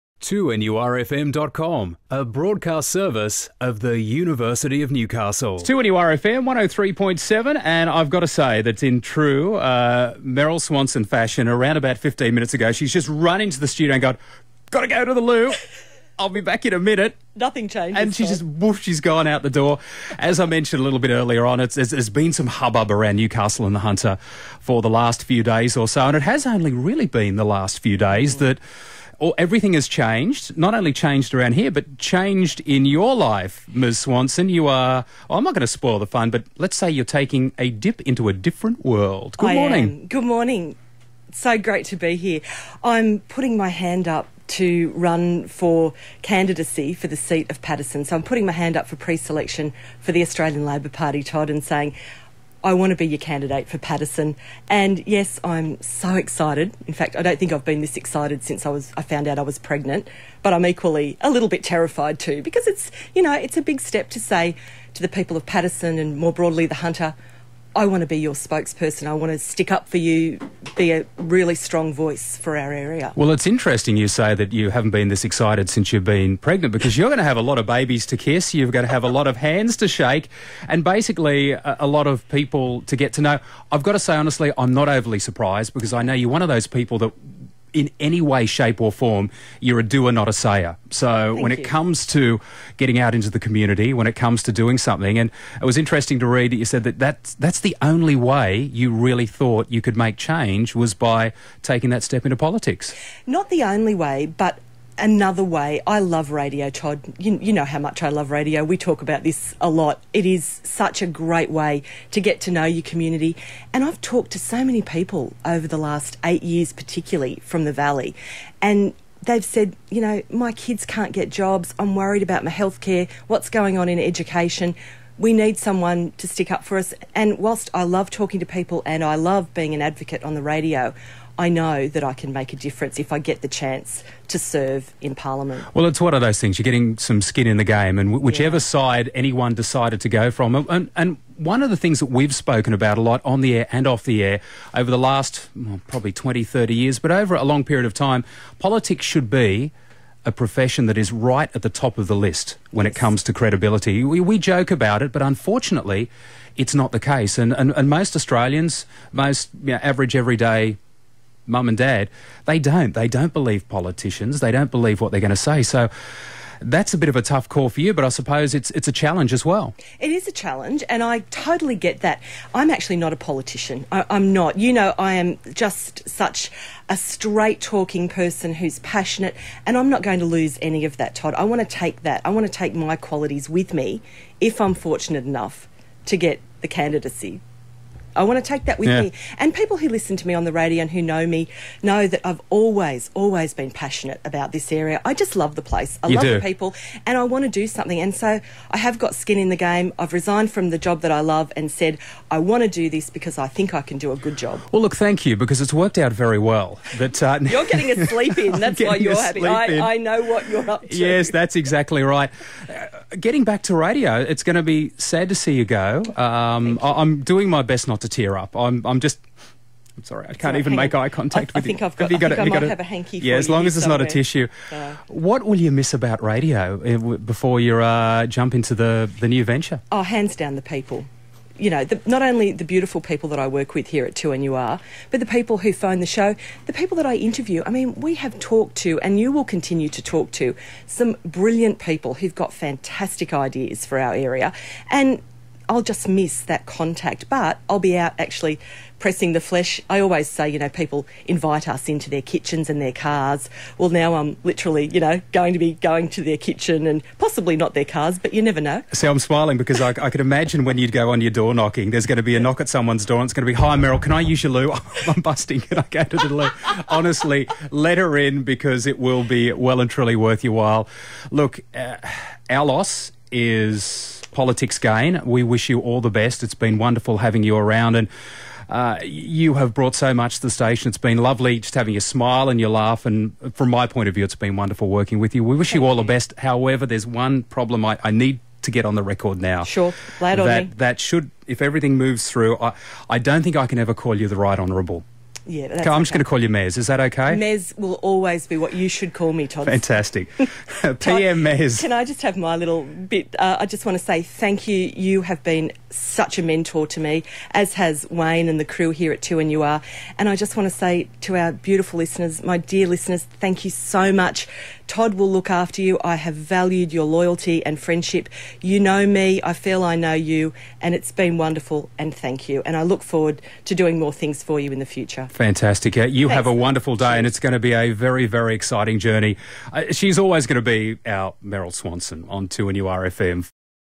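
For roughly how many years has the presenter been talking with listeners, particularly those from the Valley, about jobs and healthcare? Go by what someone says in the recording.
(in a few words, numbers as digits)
8 years.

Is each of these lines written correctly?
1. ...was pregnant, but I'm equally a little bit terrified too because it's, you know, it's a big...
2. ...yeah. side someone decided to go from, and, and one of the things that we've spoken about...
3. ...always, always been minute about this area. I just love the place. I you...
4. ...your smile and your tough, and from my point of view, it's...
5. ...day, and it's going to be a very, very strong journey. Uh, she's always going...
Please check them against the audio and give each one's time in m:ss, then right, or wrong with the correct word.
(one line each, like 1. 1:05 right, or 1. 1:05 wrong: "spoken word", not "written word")
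1. 0:59 right
2. 2:18 wrong: "anyone", not "someone"
3. 3:12 wrong: "passionate", not "minute"
4. 4:41 wrong: "laugh", not "tough"
5. 5:26 wrong: "exciting", not "strong".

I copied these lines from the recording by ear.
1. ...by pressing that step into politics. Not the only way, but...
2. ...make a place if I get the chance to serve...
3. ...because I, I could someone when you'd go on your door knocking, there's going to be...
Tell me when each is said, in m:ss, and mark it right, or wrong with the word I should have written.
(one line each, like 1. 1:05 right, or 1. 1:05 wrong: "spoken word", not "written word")
1. 1:40 wrong: "taking", not "pressing"
2. 2:12 wrong: "difference", not "place"
3. 4:19 wrong: "imagine", not "someone".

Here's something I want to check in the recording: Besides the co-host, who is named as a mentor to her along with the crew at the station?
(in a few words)
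Wayne.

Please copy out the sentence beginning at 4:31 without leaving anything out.
Look, uh, our loss is politics gain.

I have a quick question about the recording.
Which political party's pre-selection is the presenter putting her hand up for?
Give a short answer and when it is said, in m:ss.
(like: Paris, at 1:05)
Australian Labor Party, at 0:50.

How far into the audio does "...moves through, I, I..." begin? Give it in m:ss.
4:51.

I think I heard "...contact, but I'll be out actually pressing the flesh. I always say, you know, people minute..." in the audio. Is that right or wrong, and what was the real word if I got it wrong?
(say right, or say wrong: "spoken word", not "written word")
wrong: "invite", not "minute".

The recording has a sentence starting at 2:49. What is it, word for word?
It is a challenge, and I totally get that.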